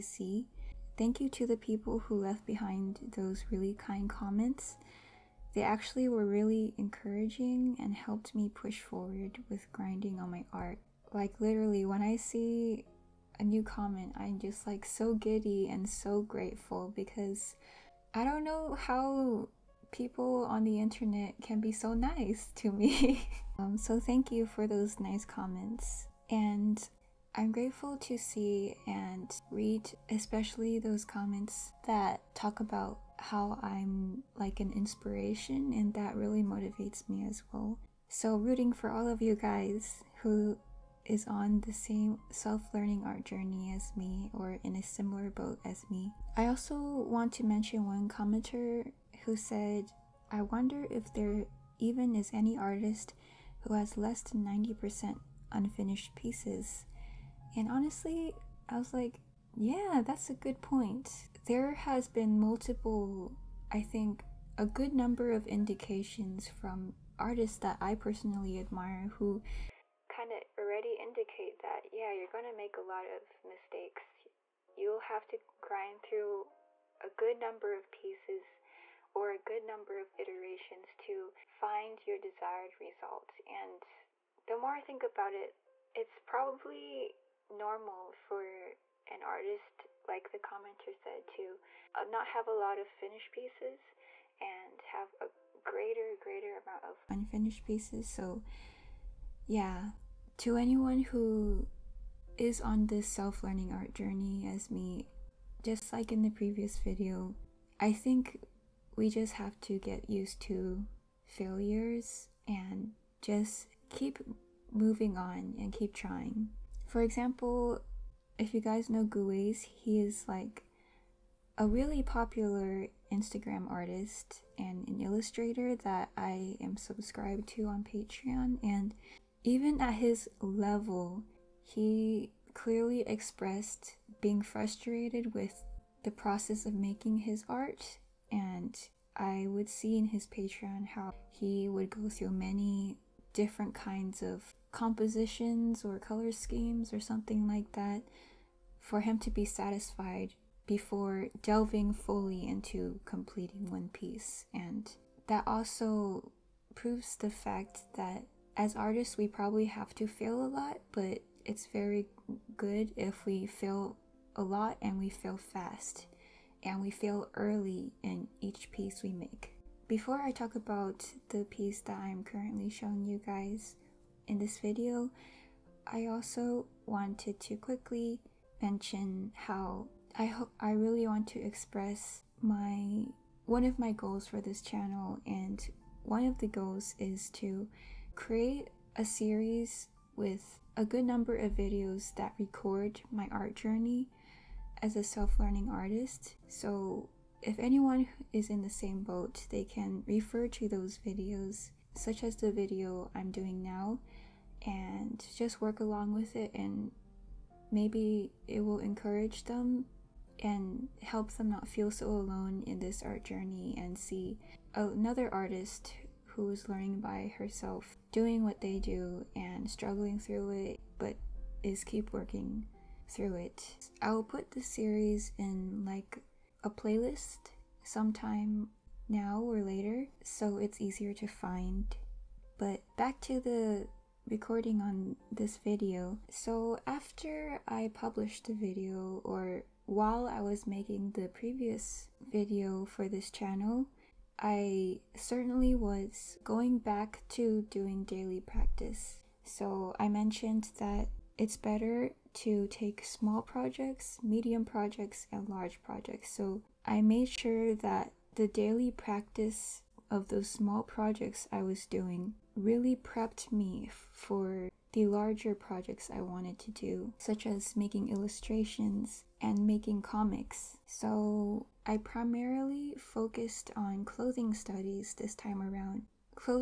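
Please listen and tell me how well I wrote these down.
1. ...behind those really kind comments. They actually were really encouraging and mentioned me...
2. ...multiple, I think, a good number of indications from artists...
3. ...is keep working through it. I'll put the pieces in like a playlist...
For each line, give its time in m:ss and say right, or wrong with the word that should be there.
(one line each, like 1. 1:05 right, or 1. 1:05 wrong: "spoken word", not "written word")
1. 0:02 wrong: "helped", not "mentioned"
2. 1:02 right
3. 3:41 wrong: "series", not "pieces".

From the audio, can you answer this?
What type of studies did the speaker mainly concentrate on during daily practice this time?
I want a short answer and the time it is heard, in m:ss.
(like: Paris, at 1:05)
Clothing studies, at 4:34.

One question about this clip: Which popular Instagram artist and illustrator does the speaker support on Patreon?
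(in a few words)
Guweiz.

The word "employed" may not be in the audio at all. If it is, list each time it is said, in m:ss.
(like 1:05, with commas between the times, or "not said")
not said.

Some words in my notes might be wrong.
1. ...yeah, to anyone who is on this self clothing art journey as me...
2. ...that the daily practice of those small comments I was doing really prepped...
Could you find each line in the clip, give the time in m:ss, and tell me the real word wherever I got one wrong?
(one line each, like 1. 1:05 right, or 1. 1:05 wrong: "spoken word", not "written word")
1. 1:39 wrong: "learning", not "clothing"
2. 4:17 wrong: "projects", not "comments".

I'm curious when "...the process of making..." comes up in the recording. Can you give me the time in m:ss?
2:16.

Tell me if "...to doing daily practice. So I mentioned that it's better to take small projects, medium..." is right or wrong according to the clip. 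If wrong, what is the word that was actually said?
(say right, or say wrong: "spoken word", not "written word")
right.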